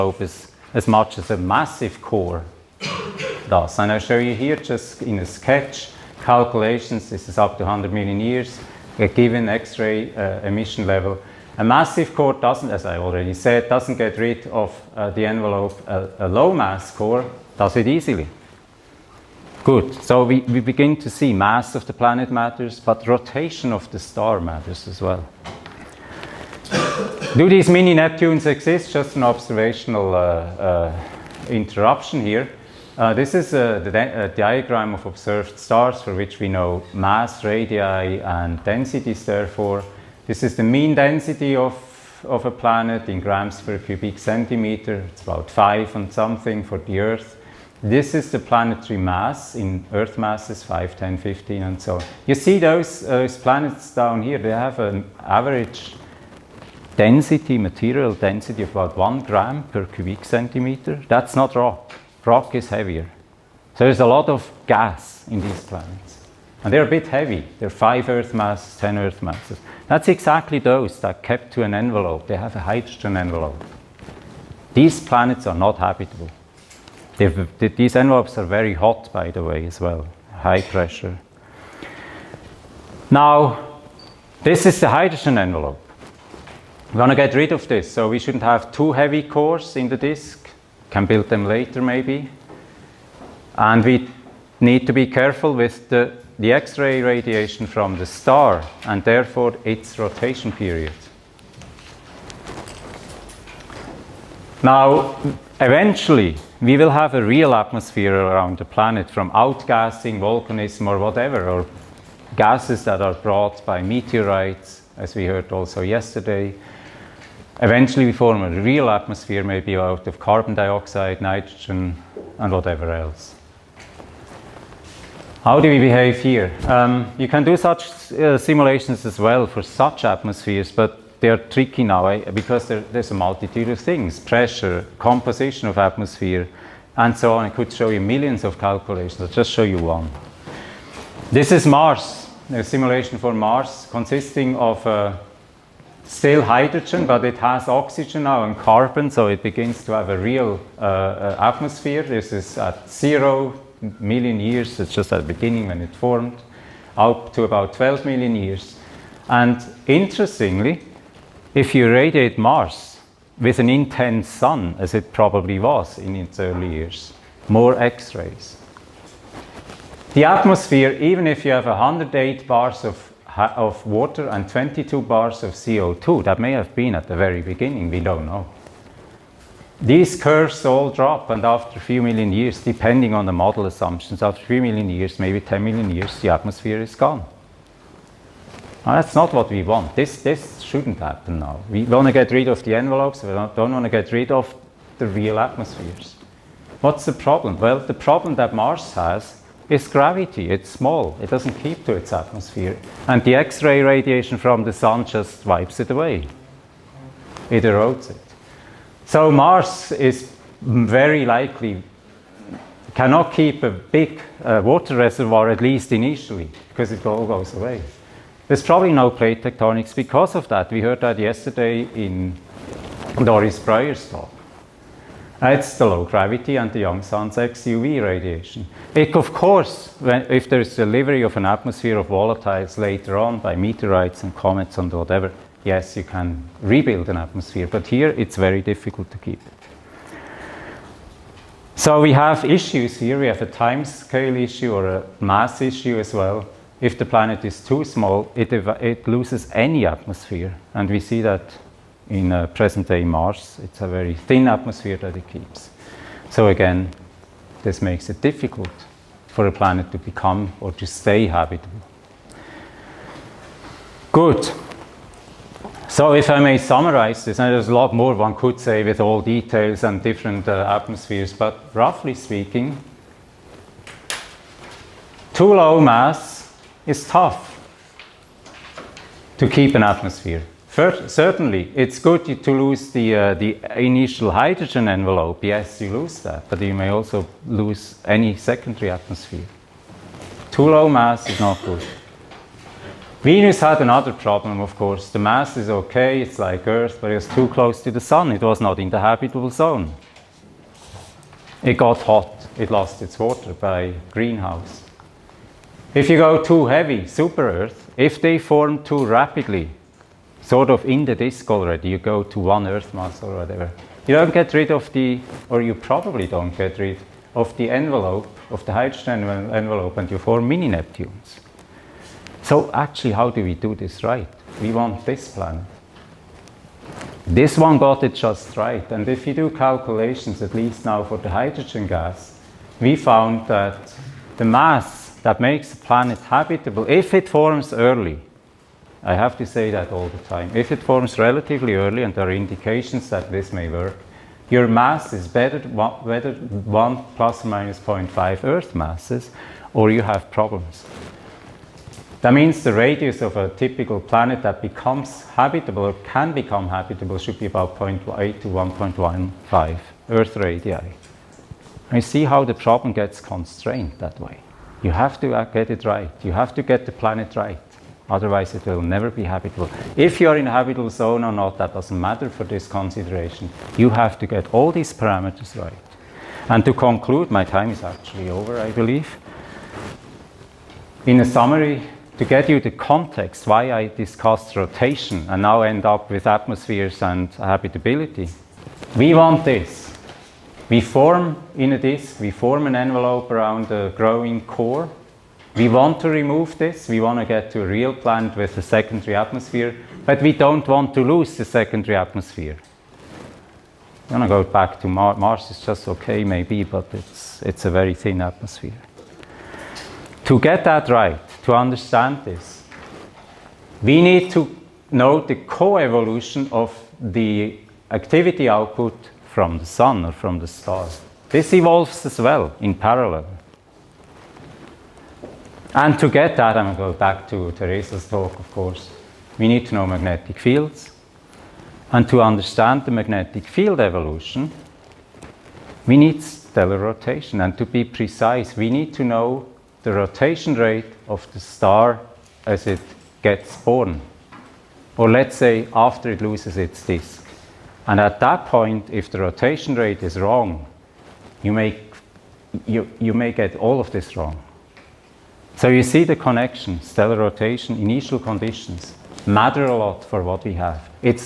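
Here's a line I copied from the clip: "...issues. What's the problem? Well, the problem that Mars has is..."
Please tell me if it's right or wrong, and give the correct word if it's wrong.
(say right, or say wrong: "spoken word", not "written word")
wrong: "atmospheres", not "issues".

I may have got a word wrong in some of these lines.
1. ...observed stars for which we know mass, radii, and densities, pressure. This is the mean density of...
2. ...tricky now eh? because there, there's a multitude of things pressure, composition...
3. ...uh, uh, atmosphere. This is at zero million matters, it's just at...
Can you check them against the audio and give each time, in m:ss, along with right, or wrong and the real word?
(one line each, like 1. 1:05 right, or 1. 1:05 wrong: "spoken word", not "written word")
1. 0:35 wrong: "therefore", not "pressure"
2. 2:11 right
3. 2:30 wrong: "years", not "matters".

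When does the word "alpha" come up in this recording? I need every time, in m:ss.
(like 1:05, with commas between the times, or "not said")
not said.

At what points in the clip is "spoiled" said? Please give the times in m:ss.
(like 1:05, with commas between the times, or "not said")
not said.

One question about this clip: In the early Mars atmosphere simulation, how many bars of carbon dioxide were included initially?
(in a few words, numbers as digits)
22.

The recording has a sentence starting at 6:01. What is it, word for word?
And see how the problem gets constrained that way.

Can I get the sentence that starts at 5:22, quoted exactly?
So actually, how do we do this right?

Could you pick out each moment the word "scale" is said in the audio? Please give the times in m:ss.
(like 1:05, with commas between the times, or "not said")
4:03.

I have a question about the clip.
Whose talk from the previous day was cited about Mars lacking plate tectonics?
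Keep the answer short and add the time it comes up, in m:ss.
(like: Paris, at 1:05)
Doris Breuer, at 3:43.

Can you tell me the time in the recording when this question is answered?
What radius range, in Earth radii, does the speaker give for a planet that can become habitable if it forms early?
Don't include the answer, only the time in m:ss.
5:57.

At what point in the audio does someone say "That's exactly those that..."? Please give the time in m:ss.
1:09.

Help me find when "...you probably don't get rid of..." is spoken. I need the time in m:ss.
5:15.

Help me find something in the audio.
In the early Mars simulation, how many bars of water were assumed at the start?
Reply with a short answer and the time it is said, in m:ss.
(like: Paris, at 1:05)
108, at 2:51.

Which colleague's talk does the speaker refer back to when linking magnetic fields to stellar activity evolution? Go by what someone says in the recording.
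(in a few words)
Teresa.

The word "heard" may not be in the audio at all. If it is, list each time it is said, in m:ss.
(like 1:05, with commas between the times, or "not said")
1:55, 3:40.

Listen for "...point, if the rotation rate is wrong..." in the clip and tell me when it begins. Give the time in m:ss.
7:28.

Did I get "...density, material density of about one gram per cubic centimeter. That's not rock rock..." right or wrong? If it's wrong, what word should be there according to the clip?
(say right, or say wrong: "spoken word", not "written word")
right.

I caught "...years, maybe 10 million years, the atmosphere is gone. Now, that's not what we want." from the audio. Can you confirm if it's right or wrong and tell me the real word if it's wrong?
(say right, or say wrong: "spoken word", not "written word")
right.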